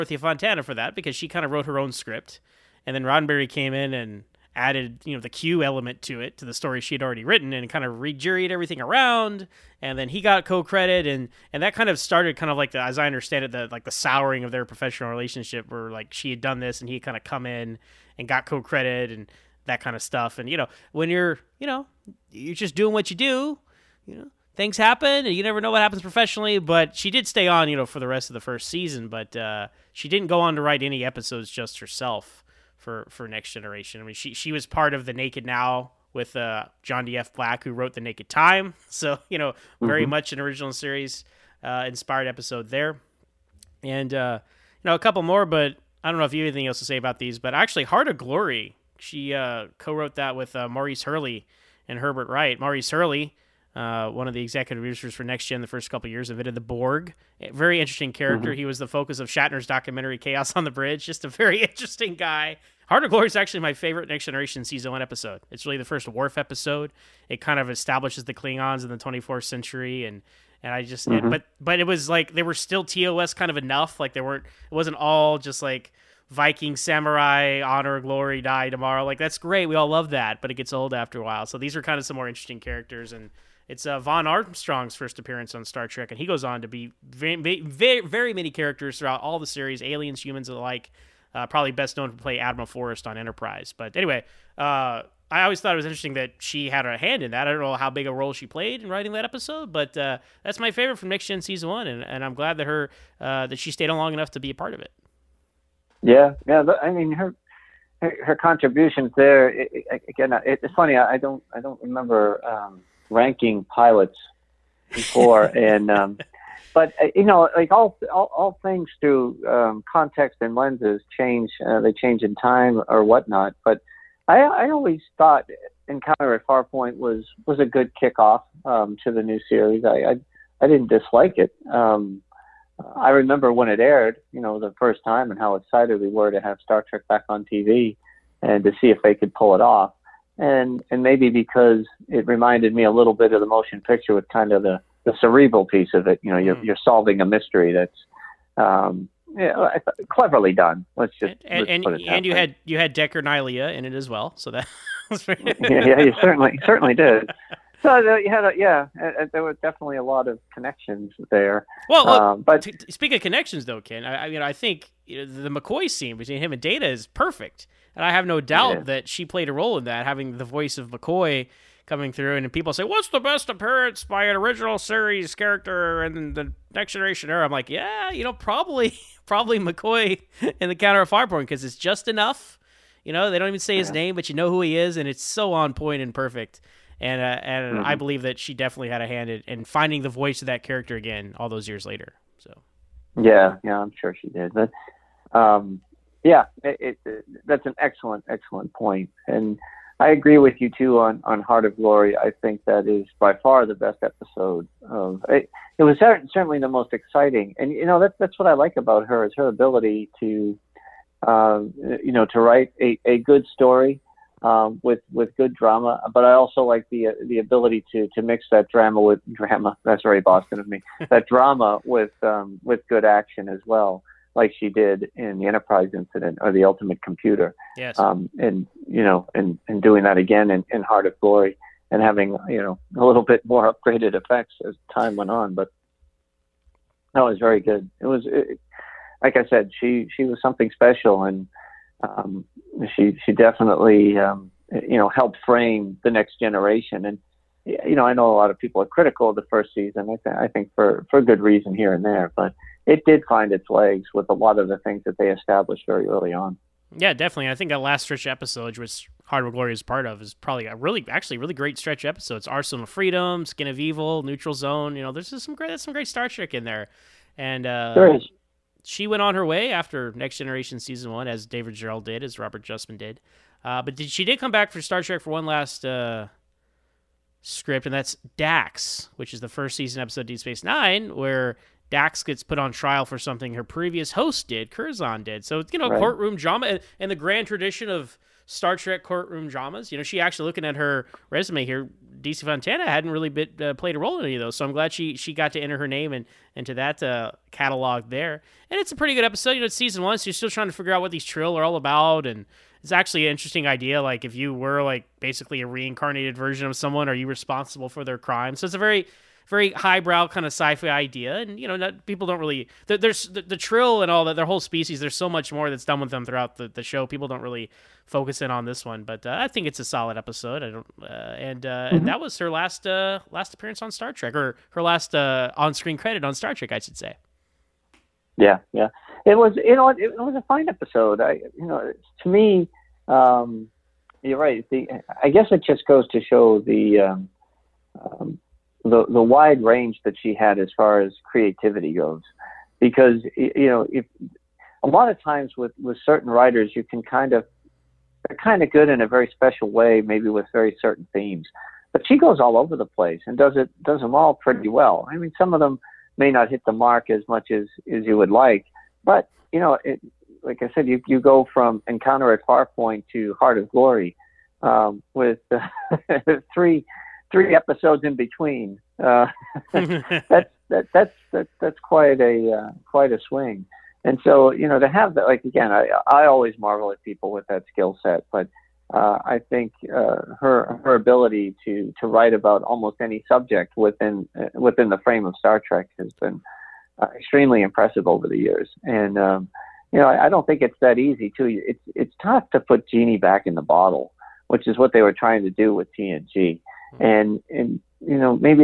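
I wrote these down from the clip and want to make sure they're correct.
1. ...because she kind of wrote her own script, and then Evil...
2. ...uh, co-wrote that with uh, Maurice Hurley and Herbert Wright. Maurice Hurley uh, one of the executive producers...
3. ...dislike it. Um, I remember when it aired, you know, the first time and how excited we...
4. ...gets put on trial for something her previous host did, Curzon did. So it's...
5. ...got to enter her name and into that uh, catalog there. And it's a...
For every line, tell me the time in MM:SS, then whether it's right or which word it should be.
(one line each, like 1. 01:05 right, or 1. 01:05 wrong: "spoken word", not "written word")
1. 00:00 wrong: "Roddenberry", not "Evil"
2. 00:49 right
3. 02:10 right
4. 04:42 right
5. 04:55 right.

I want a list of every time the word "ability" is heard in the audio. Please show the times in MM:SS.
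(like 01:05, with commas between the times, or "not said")
03:29, 03:37, 06:20.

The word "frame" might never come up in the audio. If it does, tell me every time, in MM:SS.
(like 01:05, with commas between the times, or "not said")
04:05, 06:25.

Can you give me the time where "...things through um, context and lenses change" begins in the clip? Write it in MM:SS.
01:58.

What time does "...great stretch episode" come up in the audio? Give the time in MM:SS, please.
04:21.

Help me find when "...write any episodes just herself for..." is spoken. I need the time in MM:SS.
00:30.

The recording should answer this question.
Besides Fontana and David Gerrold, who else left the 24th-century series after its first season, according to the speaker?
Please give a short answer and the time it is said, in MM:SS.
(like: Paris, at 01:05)
Robert Justman, at 04:32.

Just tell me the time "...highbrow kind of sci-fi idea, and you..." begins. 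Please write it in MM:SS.
05:09.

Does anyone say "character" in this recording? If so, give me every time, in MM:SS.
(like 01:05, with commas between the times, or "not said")
00:58, 01:22, 01:28, 02:55, 03:10.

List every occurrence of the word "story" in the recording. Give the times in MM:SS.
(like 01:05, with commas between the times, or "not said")
00:06, 03:33.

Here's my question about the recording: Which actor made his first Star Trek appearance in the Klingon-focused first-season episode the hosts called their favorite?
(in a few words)
Vaughn Armstrong.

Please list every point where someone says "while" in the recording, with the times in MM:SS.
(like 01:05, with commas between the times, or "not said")
01:21.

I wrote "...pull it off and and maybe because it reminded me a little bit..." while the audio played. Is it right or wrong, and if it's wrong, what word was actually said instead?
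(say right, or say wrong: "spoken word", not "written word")
right.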